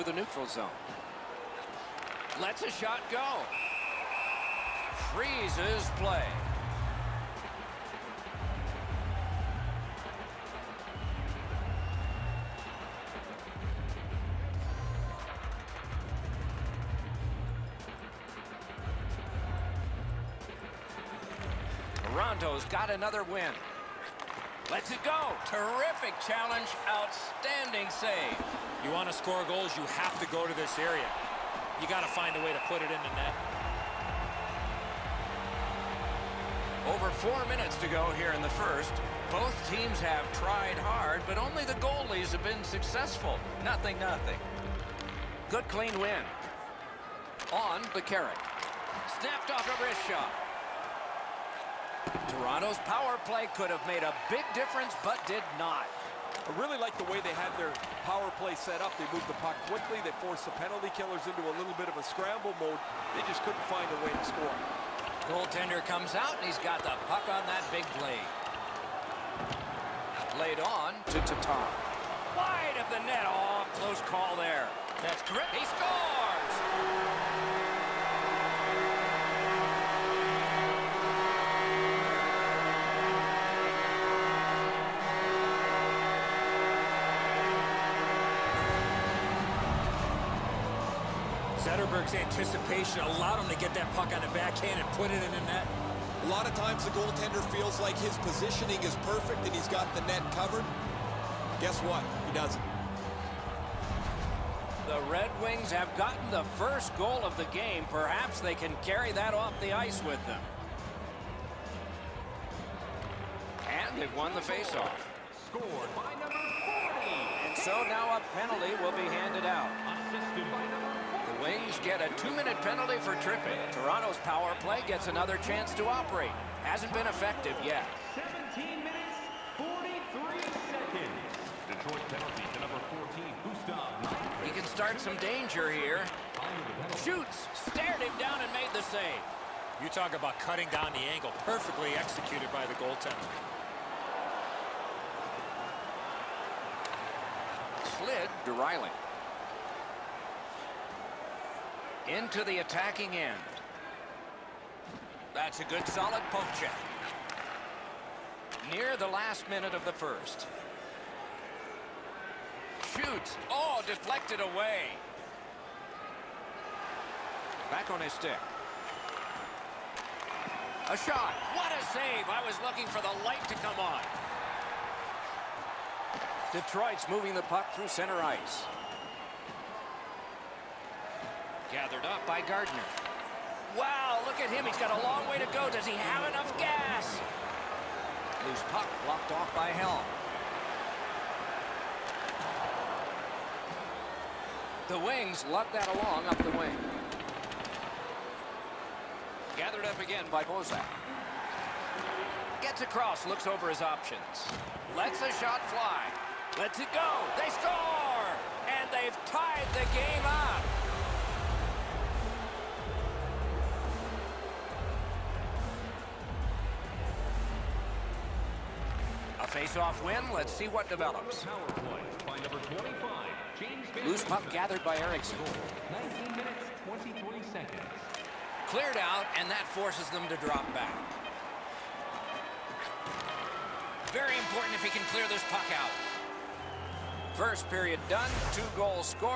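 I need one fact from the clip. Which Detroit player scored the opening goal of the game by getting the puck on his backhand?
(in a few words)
Zetterberg.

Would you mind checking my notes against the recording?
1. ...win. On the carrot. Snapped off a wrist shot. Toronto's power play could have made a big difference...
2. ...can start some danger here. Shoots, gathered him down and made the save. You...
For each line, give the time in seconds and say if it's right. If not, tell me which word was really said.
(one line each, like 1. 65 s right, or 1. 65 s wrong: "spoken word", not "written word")
1. 45 s right
2. 134 s wrong: "stared", not "gathered".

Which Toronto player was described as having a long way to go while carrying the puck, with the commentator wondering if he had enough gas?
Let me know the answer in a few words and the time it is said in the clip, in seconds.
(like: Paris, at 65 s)
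Gardiner, at 182 s.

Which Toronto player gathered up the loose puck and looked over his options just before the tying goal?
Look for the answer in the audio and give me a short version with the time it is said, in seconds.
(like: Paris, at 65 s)
Bozak, at 200 s.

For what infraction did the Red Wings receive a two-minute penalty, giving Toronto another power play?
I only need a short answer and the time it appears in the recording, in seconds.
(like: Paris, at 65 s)
Tripping, at 123 s.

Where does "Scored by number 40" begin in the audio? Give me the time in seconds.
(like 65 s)
115 s.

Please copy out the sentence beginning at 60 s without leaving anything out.
They forced the penalty killers into a little bit of a scramble mode.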